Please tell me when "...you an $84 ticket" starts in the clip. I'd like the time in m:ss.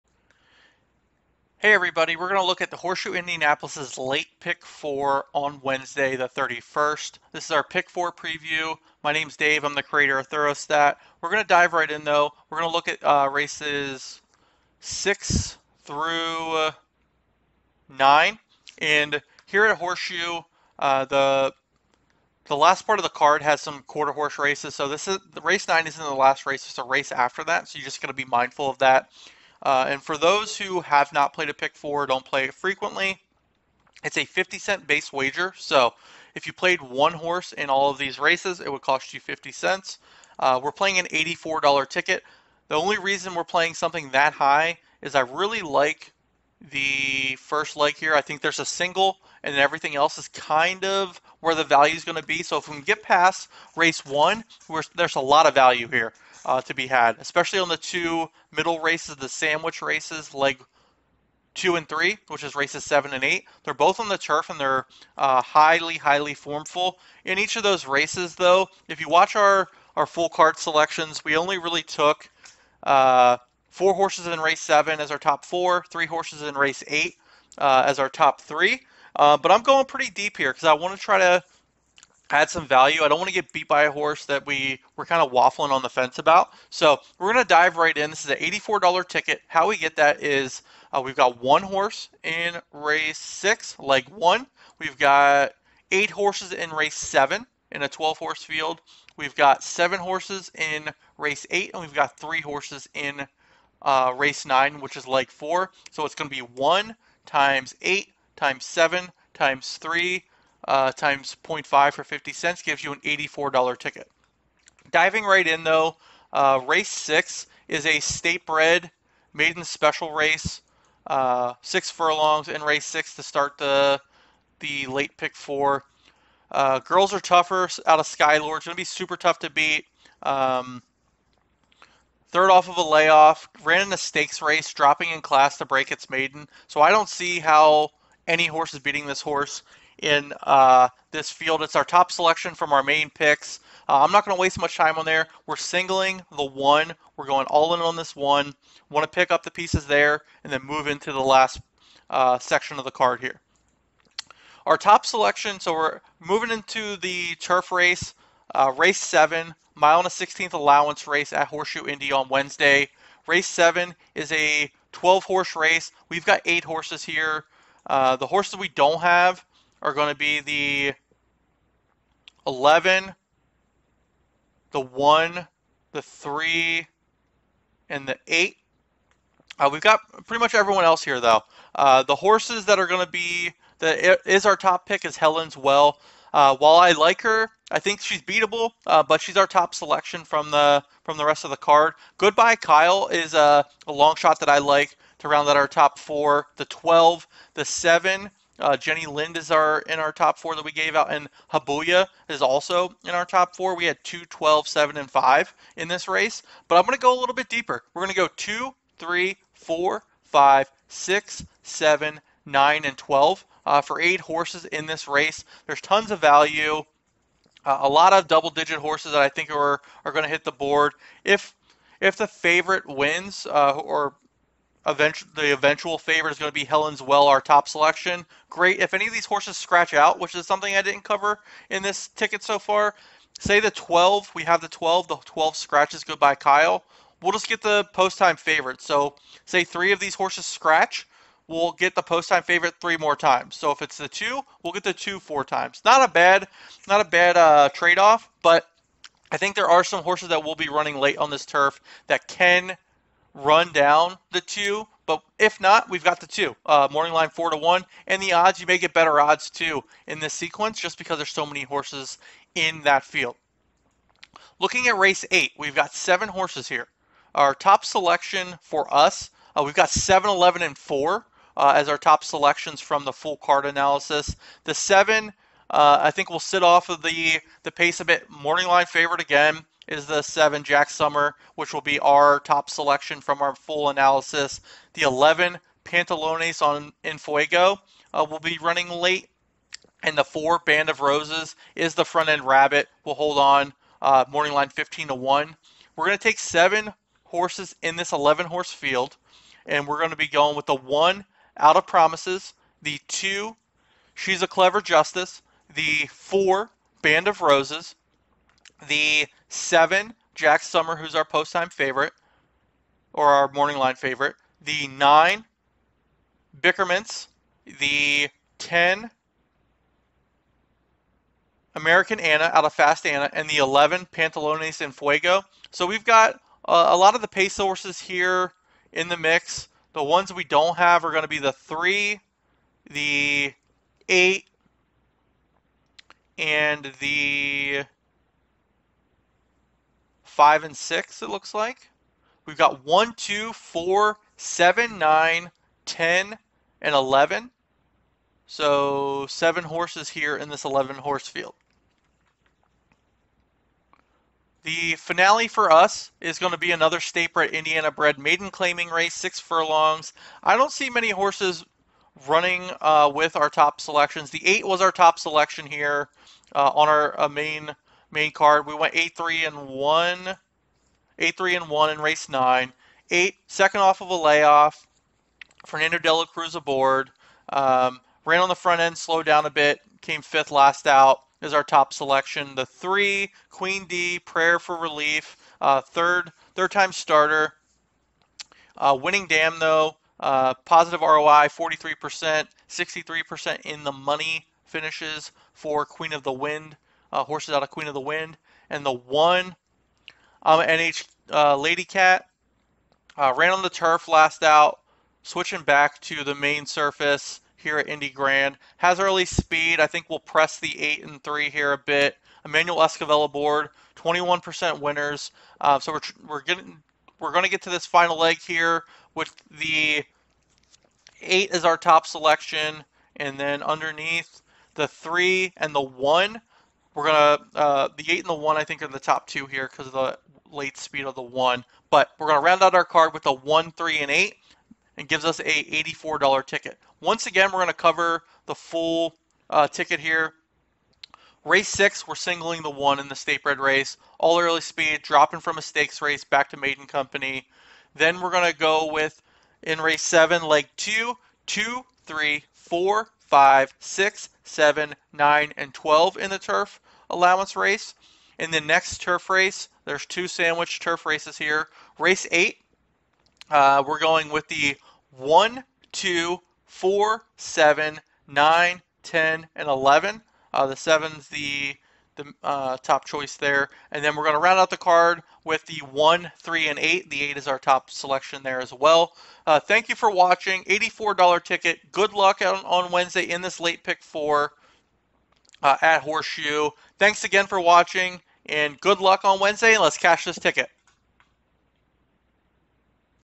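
1:52.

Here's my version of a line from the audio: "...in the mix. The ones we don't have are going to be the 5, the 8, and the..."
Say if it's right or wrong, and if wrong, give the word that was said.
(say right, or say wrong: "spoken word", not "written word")
wrong: "3", not "5".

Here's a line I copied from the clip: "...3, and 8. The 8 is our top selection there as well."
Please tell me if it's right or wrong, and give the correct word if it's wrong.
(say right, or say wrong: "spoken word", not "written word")
right.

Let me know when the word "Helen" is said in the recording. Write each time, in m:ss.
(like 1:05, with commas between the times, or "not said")
3:05, 3:46.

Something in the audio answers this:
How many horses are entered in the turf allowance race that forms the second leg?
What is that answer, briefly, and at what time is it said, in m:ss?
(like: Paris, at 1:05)
12, at 2:44.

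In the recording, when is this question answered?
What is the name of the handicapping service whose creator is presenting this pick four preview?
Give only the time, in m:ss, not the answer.
0:10.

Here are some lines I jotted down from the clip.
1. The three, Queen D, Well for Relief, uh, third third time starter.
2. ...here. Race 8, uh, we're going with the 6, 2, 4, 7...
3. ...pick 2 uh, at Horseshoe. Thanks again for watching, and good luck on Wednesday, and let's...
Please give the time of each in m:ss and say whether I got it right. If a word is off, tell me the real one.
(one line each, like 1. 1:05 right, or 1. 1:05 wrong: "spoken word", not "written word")
1. 6:22 wrong: "Prayer", not "Well"
2. 7:41 wrong: "1", not "6"
3. 8:03 wrong: "4", not "2".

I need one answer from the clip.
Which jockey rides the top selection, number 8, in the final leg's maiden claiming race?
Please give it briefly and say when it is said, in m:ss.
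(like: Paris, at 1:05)
Fernando Dela Cruz, at 6:15.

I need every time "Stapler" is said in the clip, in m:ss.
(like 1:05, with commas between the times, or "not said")
5:56.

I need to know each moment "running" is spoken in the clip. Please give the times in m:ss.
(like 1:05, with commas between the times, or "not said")
4:10, 4:48, 6:02.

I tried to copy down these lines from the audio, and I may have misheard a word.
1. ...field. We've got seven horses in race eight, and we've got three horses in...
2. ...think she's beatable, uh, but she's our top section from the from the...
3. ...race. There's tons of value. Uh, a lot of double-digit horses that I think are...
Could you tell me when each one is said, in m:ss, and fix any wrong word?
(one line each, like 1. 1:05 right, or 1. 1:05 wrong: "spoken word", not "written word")
1. 1:38 right
2. 3:07 wrong: "selection", not "section"
3. 3:35 right.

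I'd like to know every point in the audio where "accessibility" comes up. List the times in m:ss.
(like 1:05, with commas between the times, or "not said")
not said.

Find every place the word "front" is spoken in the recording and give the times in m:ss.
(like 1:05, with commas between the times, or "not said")
4:52, 6:18.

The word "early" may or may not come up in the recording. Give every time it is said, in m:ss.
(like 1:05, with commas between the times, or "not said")
6:48, 7:24.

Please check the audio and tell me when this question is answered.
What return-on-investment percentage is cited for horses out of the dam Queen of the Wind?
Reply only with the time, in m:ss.
6:31.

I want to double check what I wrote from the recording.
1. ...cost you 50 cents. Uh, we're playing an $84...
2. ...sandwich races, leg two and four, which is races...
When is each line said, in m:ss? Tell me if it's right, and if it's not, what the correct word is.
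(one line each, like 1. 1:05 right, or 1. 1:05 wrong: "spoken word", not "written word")
1. 0:38 right
2. 0:59 wrong: "three", not "four".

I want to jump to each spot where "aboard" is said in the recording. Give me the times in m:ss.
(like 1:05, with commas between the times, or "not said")
6:16, 6:53.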